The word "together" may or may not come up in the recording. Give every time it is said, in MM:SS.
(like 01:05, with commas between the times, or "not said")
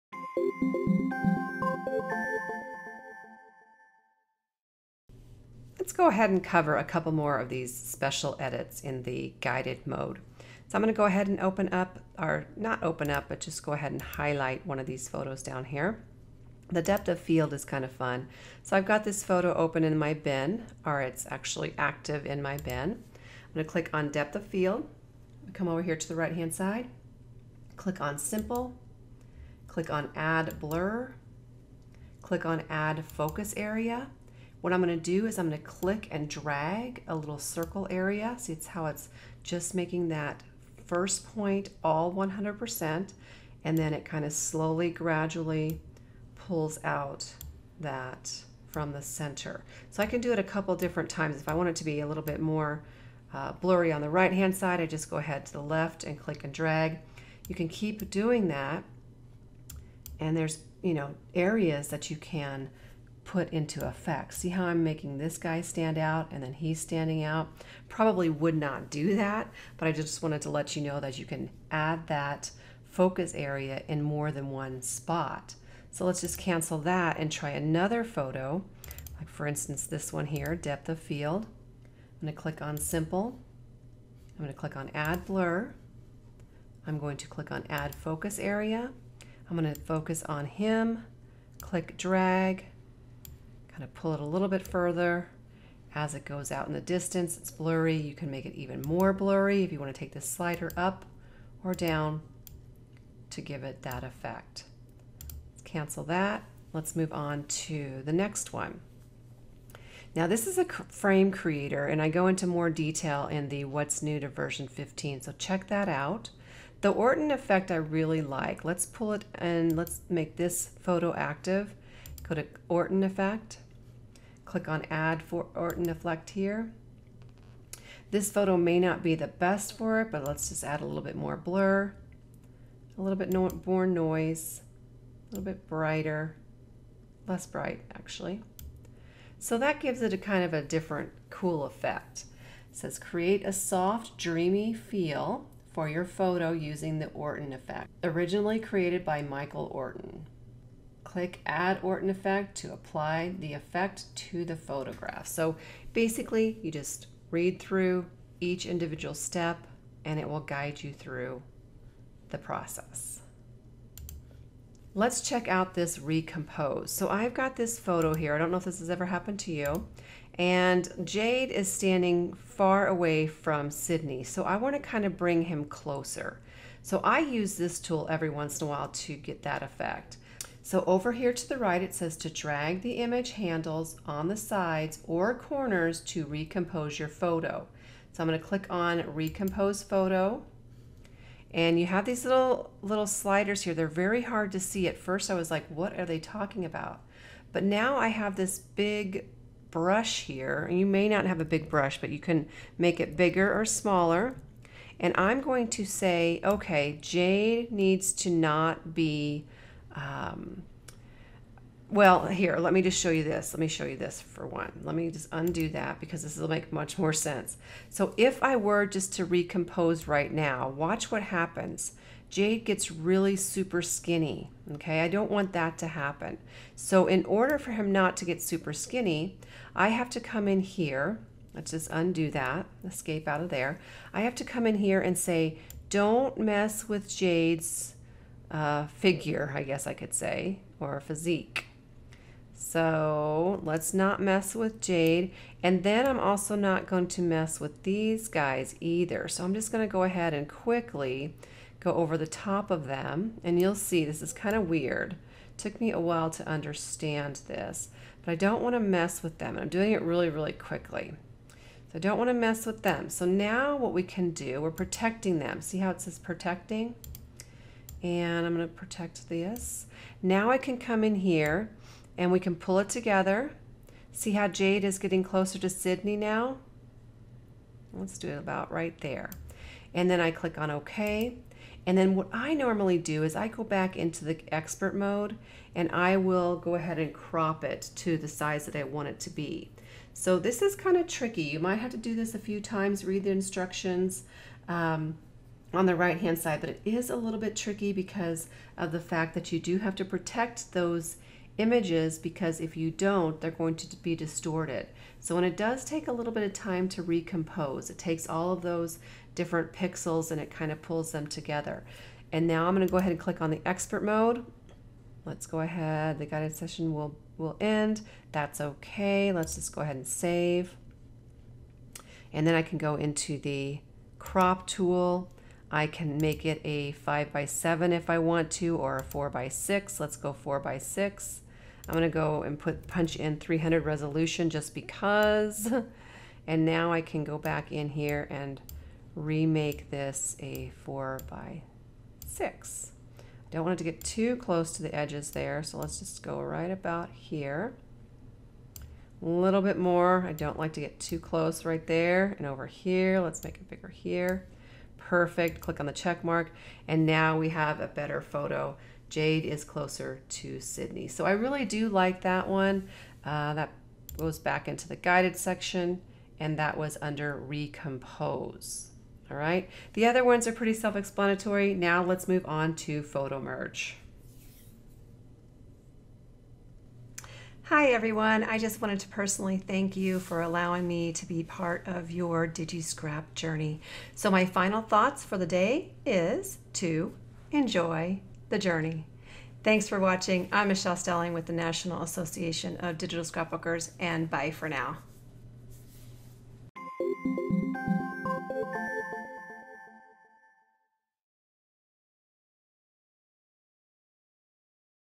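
04:32, 05:11.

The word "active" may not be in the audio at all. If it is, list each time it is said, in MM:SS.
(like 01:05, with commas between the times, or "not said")
00:21, 02:01.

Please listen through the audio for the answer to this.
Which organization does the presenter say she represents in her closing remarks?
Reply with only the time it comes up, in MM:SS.
06:31.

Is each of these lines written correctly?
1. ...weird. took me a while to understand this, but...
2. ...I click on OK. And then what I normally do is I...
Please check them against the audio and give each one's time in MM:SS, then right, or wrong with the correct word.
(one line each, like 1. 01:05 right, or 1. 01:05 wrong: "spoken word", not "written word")
1. 04:14 right
2. 04:40 right.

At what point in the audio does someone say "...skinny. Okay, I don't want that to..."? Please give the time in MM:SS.
03:43.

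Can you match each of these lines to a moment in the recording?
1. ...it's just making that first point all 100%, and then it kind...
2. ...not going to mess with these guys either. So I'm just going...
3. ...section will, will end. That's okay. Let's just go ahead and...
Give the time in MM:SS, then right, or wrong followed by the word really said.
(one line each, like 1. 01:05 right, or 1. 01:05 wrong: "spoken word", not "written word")
1. 00:38 right
2. 04:06 right
3. 05:16 wrong: "session", not "section".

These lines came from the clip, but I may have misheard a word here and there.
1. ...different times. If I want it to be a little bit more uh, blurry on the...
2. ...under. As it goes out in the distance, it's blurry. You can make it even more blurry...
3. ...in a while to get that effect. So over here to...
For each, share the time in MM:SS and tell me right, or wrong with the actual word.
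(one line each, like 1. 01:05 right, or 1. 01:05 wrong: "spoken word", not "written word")
1. 00:50 right
2. 01:34 wrong: "further", not "under"
3. 02:58 right.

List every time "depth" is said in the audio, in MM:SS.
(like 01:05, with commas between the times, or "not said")
00:16, 00:24, 01:20.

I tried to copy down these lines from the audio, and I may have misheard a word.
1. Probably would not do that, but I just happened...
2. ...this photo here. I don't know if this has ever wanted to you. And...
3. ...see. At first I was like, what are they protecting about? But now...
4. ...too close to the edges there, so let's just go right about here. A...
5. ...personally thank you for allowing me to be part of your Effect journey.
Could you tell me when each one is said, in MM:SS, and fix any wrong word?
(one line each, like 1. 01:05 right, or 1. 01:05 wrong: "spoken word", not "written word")
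1. 01:07 wrong: "wanted", not "happened"
2. 02:47 wrong: "happened", not "wanted"
3. 03:14 wrong: "talking", not "protecting"
4. 05:44 right
5. 06:19 wrong: "DigiScrap", not "Effect".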